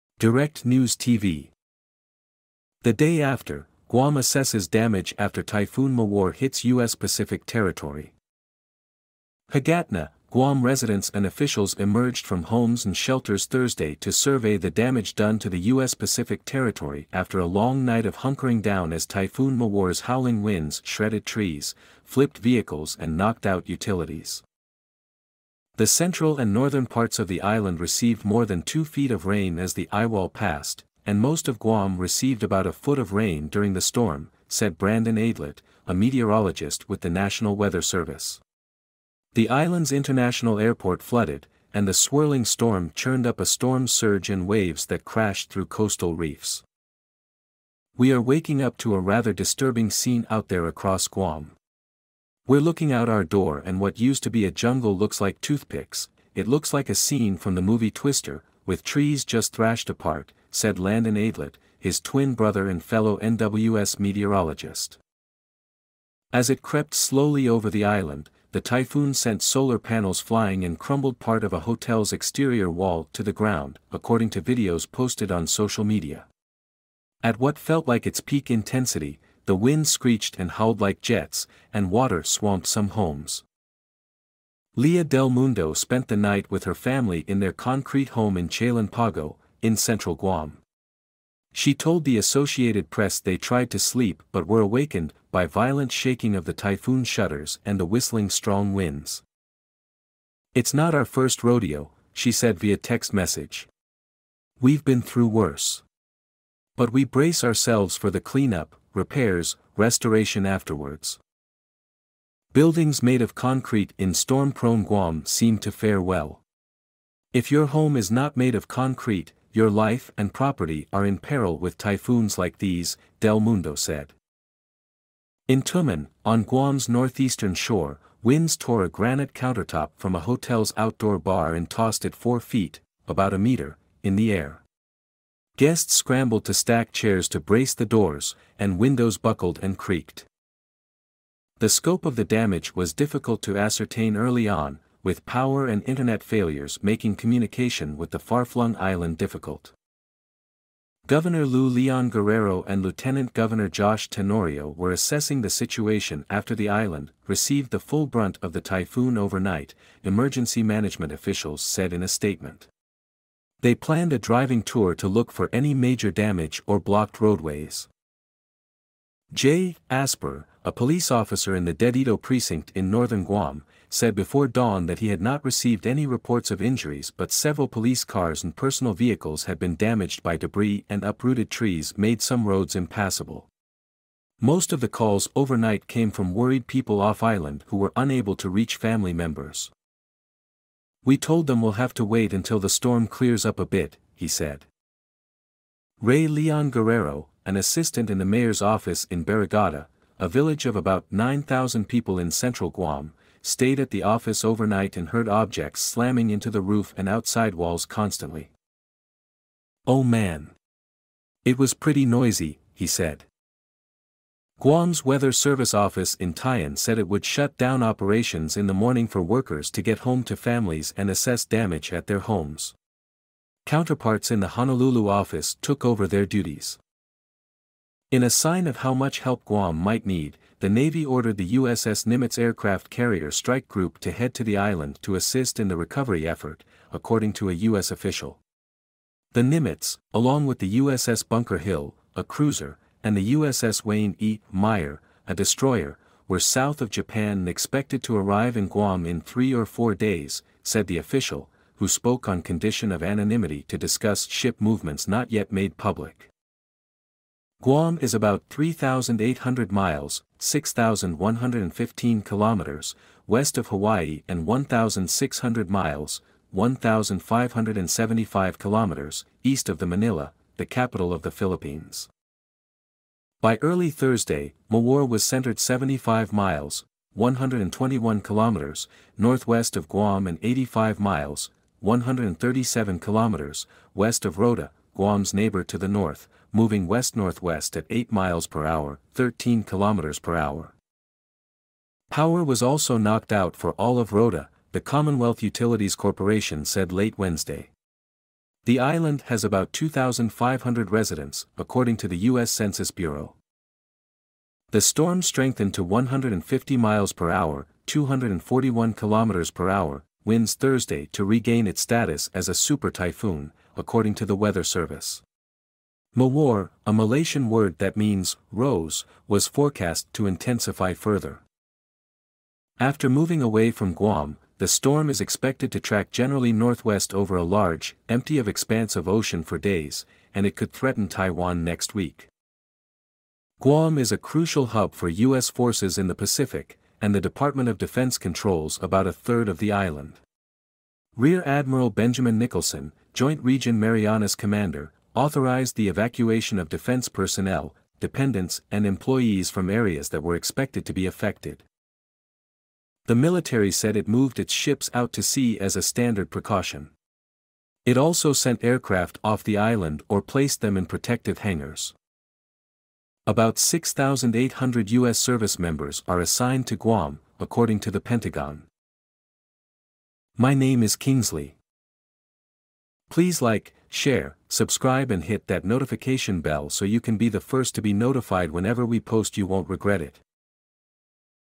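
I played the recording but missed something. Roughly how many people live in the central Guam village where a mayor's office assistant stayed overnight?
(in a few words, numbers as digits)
9,000.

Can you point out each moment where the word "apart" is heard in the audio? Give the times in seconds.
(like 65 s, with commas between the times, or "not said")
59 s.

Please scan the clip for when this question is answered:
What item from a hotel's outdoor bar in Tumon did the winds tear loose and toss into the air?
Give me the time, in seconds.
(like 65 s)
128 s.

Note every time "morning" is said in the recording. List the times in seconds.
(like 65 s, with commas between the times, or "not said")
218 s.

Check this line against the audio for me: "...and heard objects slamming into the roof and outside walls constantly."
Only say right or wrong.
right.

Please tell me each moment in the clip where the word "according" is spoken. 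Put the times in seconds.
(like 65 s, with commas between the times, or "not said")
73 s, 236 s, 301 s, 313 s, 367 s.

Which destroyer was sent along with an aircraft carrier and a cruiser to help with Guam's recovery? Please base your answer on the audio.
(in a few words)
USS Wayne E. Meyer.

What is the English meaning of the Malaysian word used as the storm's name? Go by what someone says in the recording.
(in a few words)
rose.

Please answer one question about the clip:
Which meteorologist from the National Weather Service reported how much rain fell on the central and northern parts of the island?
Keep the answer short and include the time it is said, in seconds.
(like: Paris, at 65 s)
Brandon Aydlett, at 34 s.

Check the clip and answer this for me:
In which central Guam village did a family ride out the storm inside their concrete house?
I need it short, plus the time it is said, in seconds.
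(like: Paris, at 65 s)
Chalan Pago, at 88 s.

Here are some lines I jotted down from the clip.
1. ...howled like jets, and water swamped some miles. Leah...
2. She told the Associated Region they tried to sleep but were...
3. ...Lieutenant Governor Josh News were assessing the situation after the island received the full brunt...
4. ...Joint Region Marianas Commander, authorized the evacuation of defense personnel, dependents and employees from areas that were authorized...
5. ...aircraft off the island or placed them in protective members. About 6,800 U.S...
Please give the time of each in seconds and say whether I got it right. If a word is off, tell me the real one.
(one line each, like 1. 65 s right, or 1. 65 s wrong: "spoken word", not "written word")
1. 80 s wrong: "homes", not "miles"
2. 91 s wrong: "Press", not "Region"
3. 152 s wrong: "Tenorio", not "News"
4. 343 s wrong: "expected", not "authorized"
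5. 358 s wrong: "hangars", not "members".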